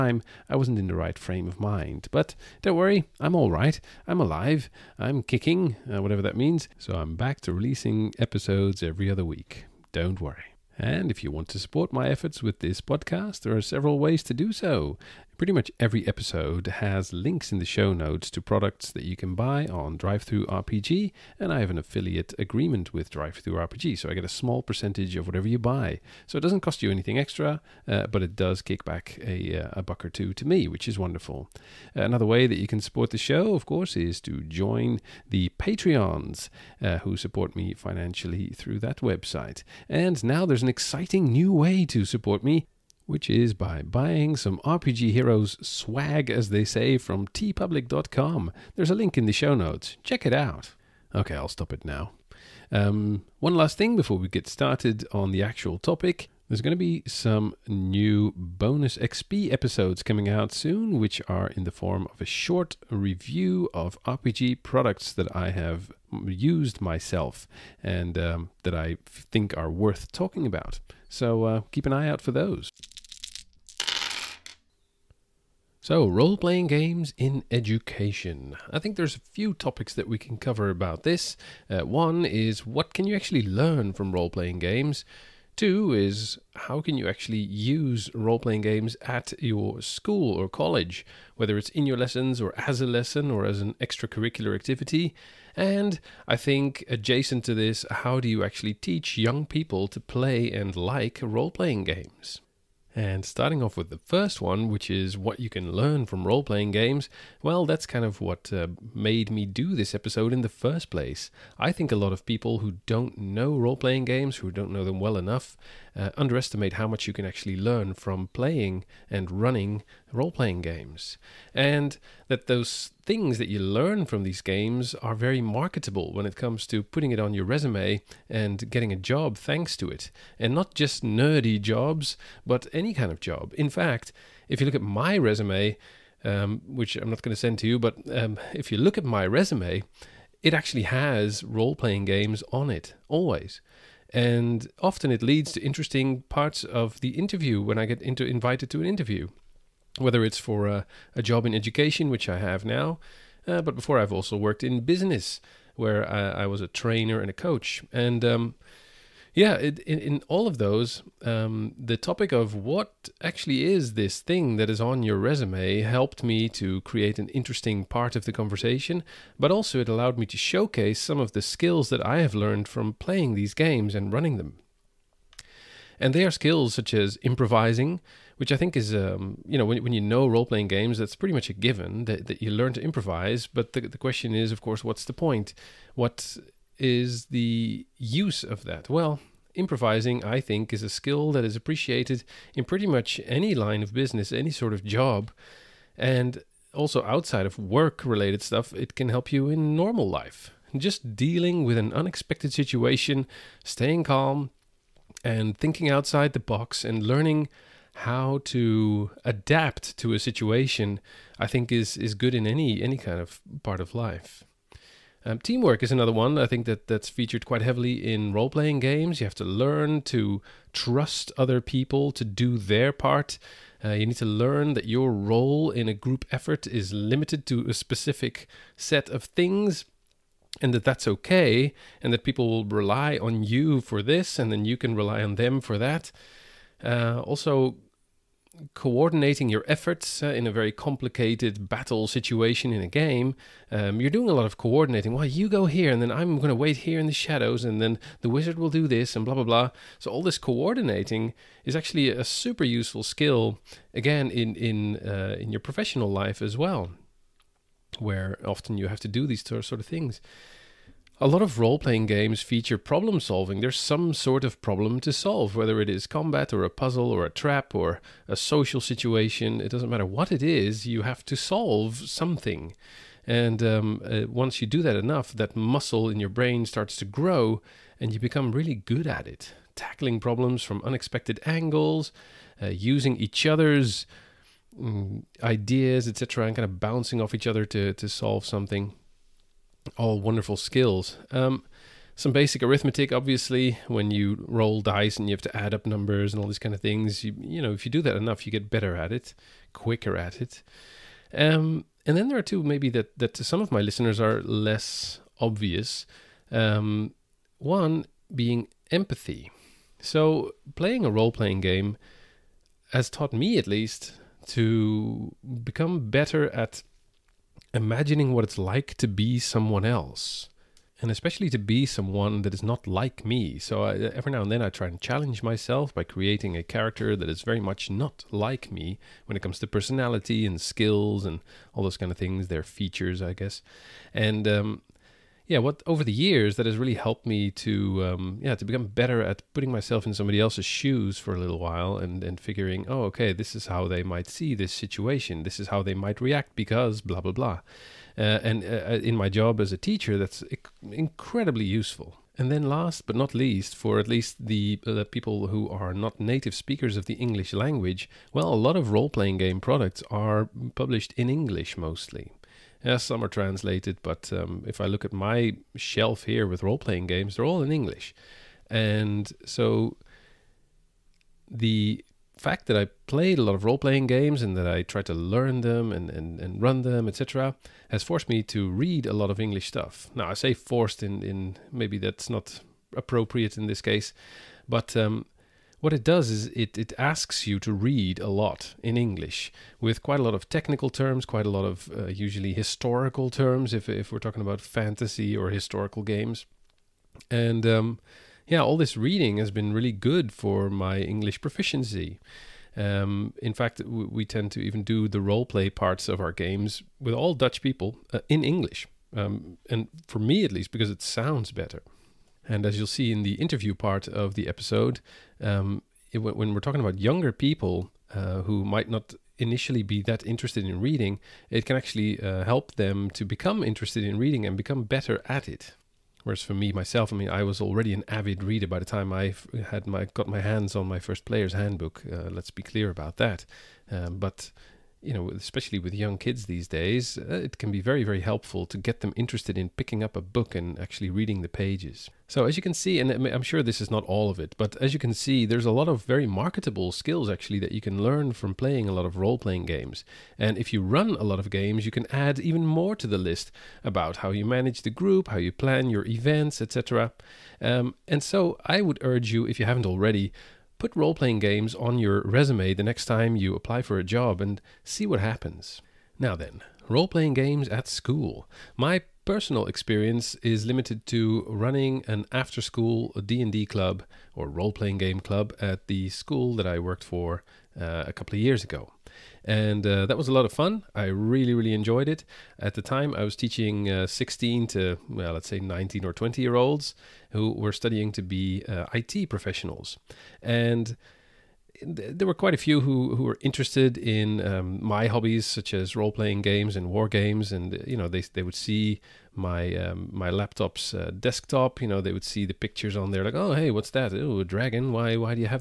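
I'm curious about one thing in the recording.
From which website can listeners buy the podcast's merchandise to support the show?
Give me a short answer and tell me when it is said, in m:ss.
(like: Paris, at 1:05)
teepublic.com, at 0:47.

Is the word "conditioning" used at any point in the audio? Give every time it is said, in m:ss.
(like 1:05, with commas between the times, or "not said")
not said.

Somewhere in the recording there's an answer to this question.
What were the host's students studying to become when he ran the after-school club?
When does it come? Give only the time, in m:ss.
8:08.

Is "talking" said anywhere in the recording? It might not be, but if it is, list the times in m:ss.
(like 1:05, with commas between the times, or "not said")
1:10, 6:34, 6:56.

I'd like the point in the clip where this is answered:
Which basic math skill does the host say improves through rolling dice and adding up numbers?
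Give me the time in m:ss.
4:52.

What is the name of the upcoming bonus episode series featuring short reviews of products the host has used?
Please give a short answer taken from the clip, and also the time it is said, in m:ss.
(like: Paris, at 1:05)
Bonus XP, at 0:58.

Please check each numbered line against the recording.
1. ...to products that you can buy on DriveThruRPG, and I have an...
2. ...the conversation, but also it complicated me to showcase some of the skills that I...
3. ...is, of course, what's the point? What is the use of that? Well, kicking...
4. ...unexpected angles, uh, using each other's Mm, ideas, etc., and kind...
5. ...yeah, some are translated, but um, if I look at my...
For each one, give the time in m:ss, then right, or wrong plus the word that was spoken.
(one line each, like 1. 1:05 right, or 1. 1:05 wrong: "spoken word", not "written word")
1. 0:18 right
2. 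2:48 wrong: "allowed", not "complicated"
3. 3:04 wrong: "improvising", not "kicking"
4. 4:40 right
5. 6:02 right.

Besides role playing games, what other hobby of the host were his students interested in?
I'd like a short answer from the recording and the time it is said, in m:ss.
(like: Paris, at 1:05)
war games, at 8:16.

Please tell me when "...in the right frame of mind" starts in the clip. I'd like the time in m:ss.
0:00.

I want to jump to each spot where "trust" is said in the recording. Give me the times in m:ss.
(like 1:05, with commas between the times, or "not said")
3:40.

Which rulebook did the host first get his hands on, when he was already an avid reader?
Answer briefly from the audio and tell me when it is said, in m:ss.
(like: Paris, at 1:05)
Player's Handbook, at 7:11.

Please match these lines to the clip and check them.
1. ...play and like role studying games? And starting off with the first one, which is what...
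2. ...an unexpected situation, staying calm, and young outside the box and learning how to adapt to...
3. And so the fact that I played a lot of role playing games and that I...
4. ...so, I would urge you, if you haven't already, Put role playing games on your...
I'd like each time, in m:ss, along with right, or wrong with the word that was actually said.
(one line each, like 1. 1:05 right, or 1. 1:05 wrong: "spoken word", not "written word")
1. 1:39 wrong: "playing", not "studying"
2. 3:21 wrong: "thinking", not "young"
3. 6:08 right
4. 7:38 right.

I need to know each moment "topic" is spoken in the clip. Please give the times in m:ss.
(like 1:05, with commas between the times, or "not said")
0:55, 1:19, 2:41.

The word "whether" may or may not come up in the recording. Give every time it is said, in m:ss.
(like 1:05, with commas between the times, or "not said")
1:31, 2:29, 4:25.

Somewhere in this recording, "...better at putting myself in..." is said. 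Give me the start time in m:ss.
5:38.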